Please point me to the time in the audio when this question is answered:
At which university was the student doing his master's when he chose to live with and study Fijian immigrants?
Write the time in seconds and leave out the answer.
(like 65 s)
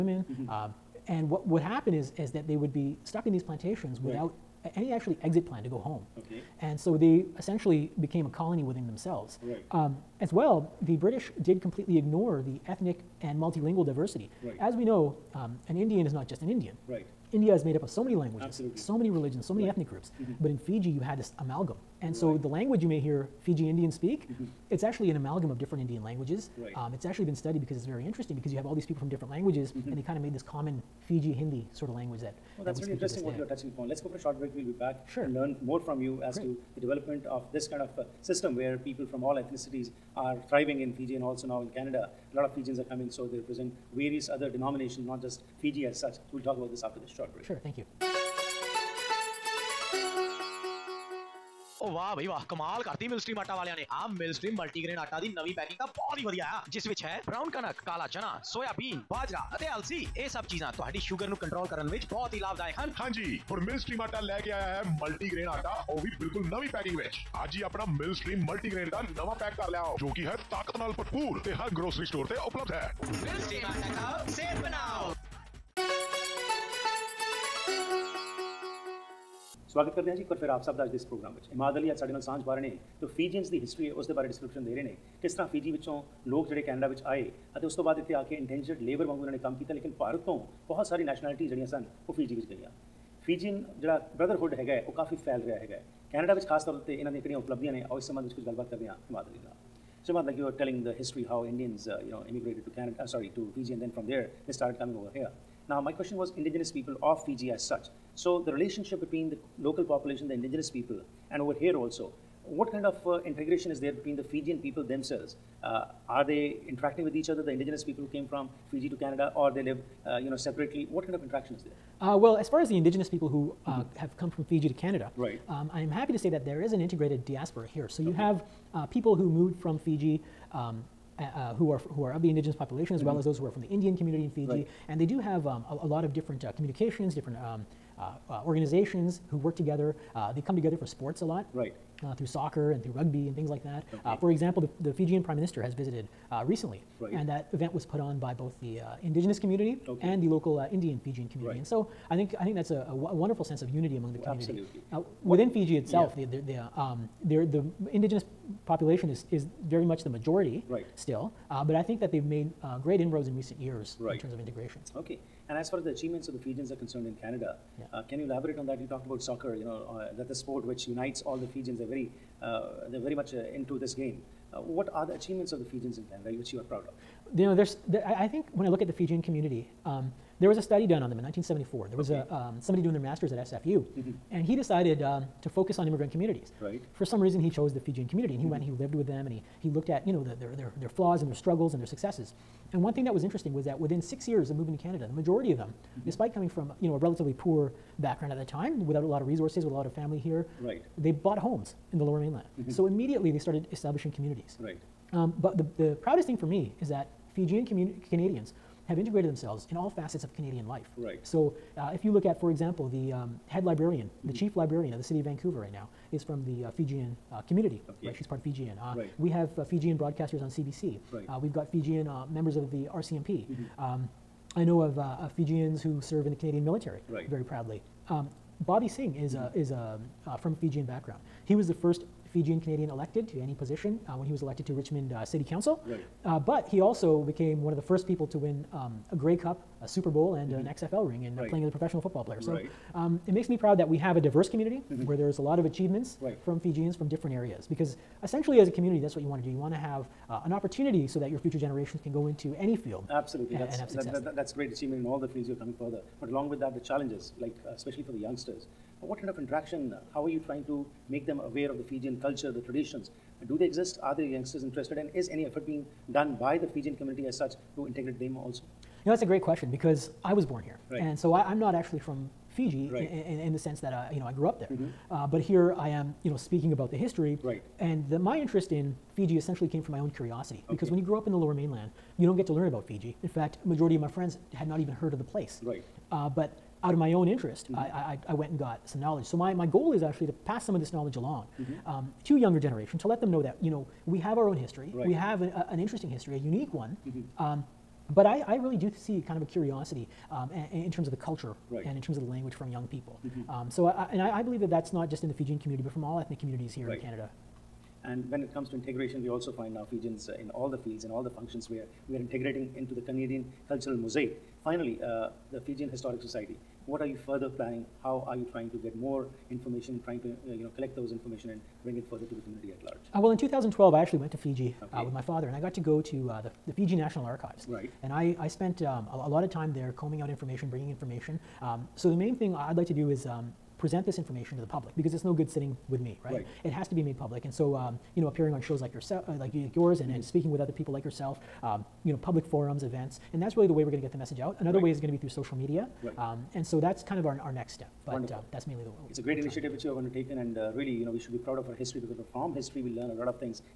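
183 s.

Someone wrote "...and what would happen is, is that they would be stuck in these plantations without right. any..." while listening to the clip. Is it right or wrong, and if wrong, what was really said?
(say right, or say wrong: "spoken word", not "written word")
right.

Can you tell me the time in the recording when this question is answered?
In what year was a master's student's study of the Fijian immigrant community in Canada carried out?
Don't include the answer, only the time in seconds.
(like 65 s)
181 s.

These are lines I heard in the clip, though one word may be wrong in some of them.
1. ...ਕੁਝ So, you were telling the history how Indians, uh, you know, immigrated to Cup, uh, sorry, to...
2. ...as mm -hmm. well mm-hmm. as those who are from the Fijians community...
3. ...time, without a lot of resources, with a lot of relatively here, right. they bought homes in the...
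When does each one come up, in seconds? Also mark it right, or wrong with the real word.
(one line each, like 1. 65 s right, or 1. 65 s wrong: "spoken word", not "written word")
1. 98 s wrong: "Canada", not "Cup"
2. 132 s wrong: "Indian", not "Fijians"
3. 198 s wrong: "family", not "relatively".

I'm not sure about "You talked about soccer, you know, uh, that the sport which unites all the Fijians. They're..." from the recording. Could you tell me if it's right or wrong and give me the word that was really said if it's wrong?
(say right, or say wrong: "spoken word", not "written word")
right.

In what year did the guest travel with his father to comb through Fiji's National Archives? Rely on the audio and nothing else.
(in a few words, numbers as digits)
2012.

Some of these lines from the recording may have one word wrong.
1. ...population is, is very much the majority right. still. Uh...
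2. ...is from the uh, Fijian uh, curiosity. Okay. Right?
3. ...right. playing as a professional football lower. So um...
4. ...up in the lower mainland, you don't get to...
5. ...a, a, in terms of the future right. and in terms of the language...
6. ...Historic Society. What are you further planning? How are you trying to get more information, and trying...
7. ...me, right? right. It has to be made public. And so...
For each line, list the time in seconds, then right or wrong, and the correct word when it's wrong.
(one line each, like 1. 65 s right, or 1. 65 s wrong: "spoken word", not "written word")
1. 158 s right
2. 216 s wrong: "community", not "curiosity"
3. 241 s wrong: "player", not "lower"
4. 281 s right
5. 300 s wrong: "culture", not "future"
6. 315 s right
7. 335 s right.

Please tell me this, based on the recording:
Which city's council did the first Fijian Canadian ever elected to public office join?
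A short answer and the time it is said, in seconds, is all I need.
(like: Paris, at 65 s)
Richmond, at 234 s.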